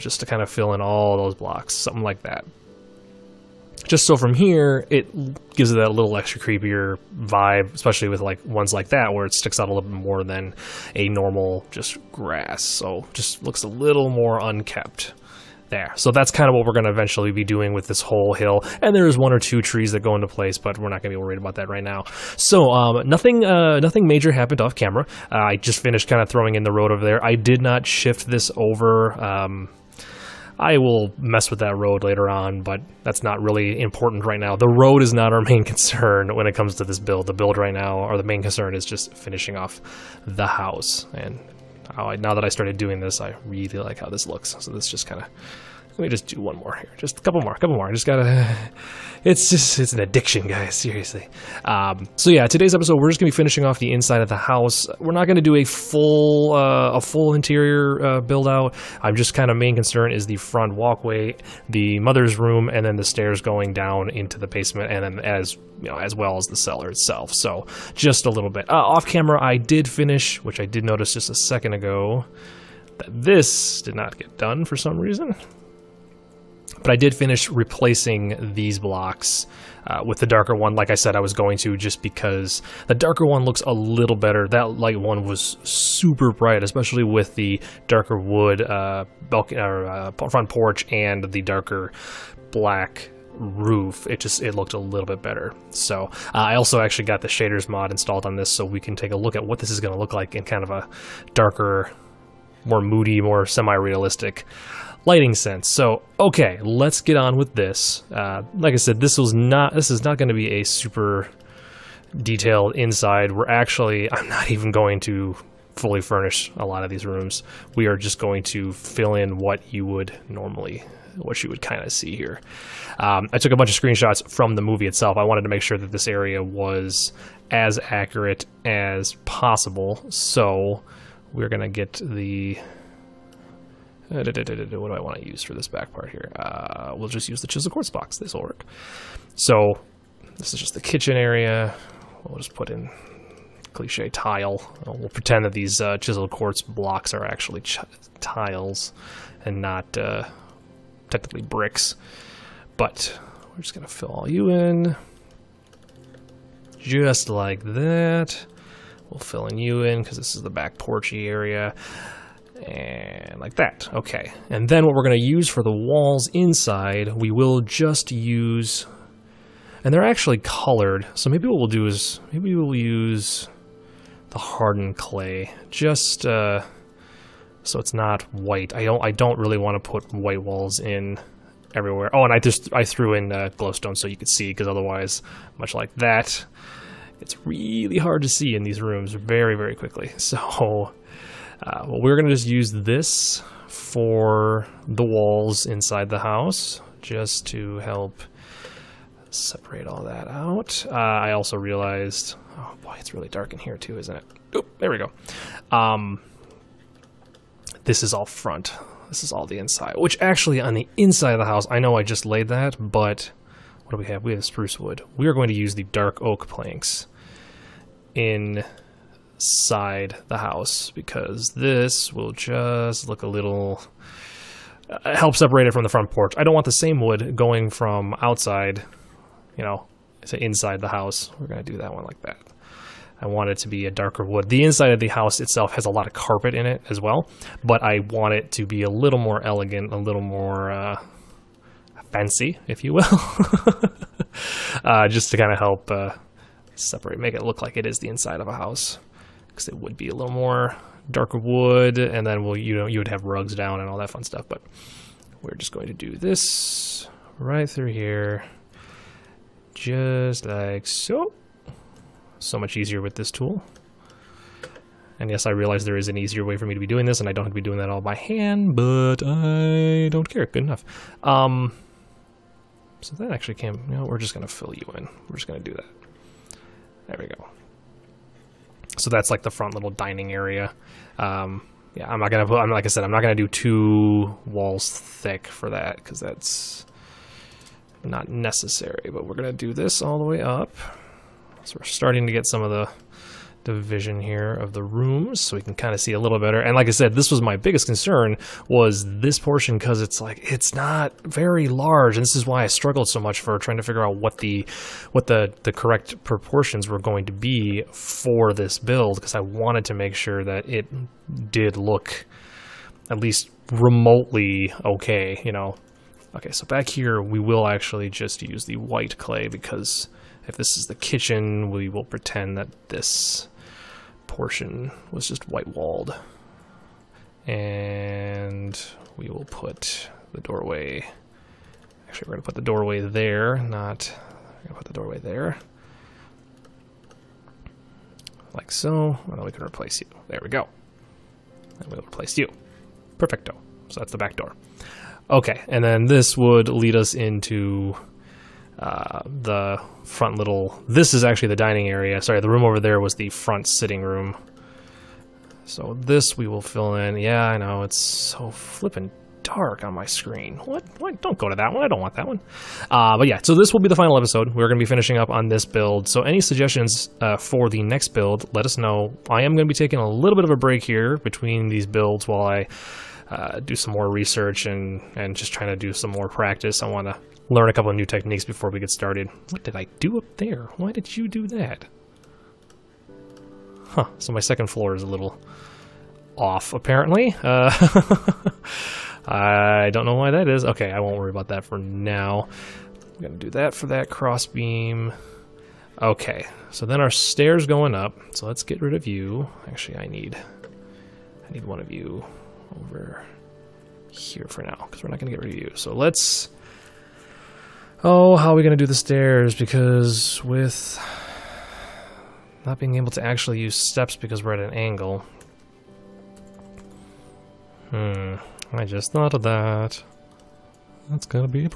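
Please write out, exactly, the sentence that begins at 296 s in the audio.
And like I said, this was my biggest concern was this portion because it's like it's not very large.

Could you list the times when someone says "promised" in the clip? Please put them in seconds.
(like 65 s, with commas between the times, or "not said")
not said.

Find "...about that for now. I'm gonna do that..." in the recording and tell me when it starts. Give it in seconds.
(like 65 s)
391 s.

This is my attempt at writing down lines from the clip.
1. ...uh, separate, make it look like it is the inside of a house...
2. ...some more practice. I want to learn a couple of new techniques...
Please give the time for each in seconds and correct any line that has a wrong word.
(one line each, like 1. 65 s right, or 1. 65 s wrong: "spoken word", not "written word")
1. 245 s right
2. 375 s right.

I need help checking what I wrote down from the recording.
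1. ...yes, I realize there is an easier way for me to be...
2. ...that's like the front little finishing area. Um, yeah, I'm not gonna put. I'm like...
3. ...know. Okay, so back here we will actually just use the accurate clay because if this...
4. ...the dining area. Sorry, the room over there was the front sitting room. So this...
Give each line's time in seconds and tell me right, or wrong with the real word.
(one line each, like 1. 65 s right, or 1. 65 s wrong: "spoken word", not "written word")
1. 265 s right
2. 279 s wrong: "dining", not "finishing"
3. 315 s wrong: "white", not "accurate"
4. 351 s right.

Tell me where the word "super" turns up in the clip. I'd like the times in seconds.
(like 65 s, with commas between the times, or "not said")
85 s, 110 s.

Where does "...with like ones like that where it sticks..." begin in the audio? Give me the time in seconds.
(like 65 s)
8 s.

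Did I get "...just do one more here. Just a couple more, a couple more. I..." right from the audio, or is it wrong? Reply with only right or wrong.
right.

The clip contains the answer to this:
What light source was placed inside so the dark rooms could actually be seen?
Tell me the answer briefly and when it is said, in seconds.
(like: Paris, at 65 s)
glowstone, at 183 s.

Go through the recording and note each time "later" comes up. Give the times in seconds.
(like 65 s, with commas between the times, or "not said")
32 s.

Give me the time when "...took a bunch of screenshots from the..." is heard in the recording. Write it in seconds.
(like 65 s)
123 s.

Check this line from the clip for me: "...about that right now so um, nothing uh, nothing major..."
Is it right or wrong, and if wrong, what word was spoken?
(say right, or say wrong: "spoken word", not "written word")
right.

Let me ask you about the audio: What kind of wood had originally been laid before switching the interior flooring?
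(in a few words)
spruce wood.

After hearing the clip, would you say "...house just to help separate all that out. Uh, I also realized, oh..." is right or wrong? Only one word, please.
right.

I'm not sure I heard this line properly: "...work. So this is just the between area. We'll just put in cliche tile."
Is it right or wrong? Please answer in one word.
wrong.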